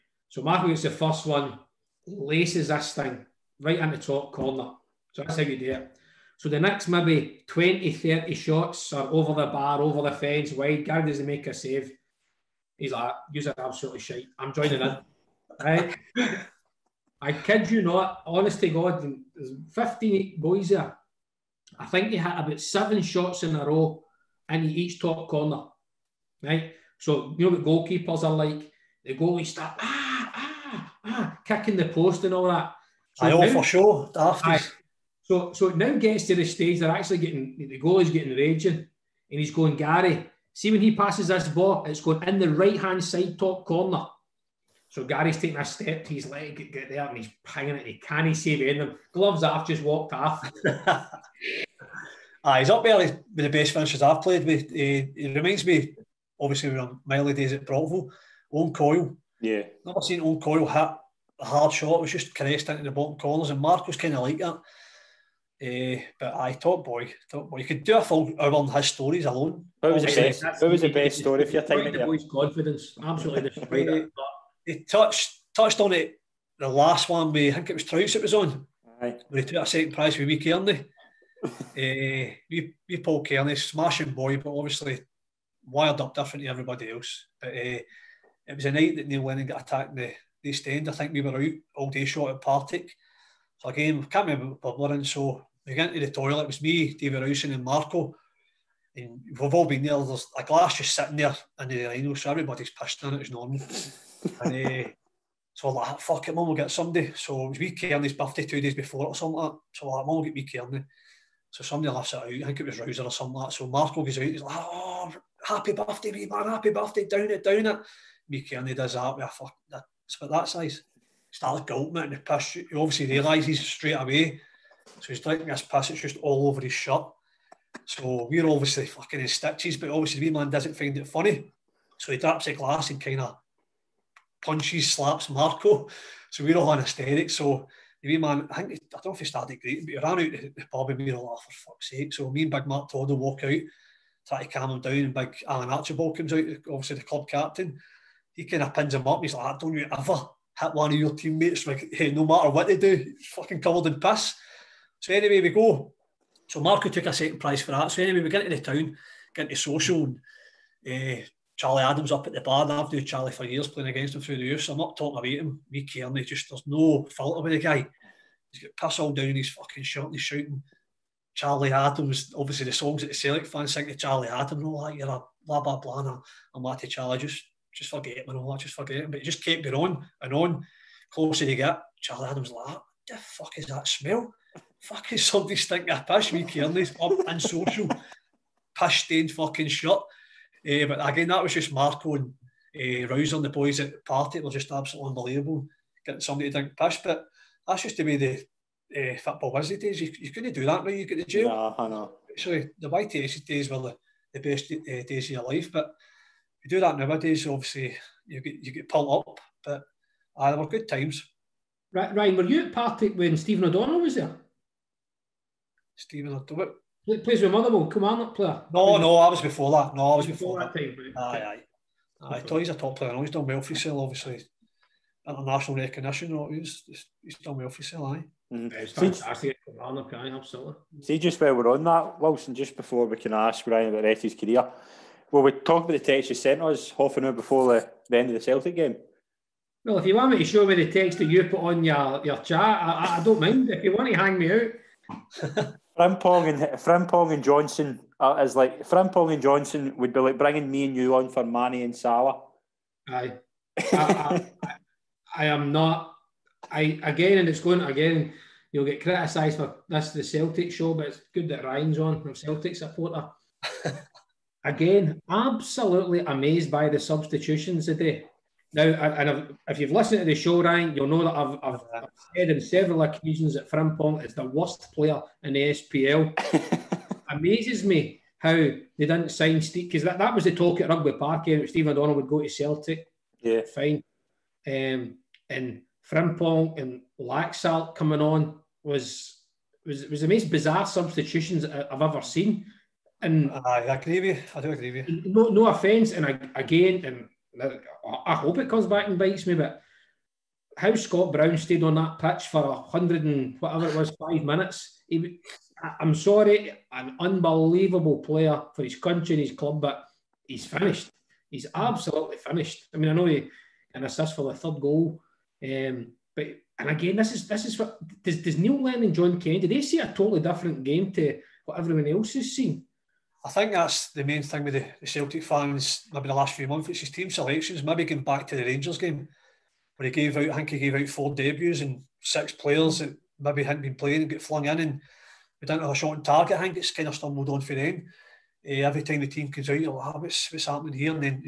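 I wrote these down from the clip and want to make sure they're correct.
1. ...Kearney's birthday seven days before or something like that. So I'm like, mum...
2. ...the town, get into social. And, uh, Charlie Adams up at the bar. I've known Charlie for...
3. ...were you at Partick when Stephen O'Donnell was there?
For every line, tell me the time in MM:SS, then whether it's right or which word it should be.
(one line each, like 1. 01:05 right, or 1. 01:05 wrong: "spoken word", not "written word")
1. 01:47 wrong: "two", not "seven"
2. 02:38 right
3. 03:32 right.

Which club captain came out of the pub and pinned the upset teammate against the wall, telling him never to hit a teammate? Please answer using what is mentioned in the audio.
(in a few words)
Alan Archibald.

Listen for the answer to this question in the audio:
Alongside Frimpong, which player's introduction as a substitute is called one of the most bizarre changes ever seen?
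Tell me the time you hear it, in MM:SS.
04:47.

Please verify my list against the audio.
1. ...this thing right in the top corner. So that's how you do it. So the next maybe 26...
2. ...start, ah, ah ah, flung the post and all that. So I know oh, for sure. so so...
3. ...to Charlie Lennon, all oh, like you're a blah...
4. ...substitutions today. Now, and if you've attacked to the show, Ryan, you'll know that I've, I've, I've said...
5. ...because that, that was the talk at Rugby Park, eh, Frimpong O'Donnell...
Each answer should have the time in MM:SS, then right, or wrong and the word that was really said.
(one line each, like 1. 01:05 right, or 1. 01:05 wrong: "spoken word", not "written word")
1. 00:02 wrong: "20", not "26"
2. 00:29 wrong: "kicking", not "flung"
3. 02:53 wrong: "Adams", not "Lennon"
4. 04:26 wrong: "listened", not "attacked"
5. 04:39 wrong: "Steve", not "Frimpong".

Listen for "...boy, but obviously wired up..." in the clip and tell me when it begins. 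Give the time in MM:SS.
01:24.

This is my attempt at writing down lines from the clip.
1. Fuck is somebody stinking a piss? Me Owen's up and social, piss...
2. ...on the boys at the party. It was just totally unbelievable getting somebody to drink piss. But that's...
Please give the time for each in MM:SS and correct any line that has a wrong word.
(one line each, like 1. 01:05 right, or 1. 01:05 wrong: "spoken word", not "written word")
1. 03:04 wrong: "Kearney", not "Owen"
2. 03:13 wrong: "absolutely", not "totally".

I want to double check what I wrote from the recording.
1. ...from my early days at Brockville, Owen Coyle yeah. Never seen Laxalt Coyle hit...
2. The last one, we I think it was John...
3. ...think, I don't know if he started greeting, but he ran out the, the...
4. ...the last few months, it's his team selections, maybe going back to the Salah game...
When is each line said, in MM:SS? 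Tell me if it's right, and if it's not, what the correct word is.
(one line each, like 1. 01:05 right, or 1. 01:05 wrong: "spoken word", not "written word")
1. 00:56 wrong: "Owen", not "Laxalt"
2. 01:16 wrong: "Trouse", not "John"
3. 02:18 right
4. 05:26 wrong: "Rangers", not "Salah".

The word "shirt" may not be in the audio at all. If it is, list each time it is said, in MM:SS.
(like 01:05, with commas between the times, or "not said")
02:06, 02:49.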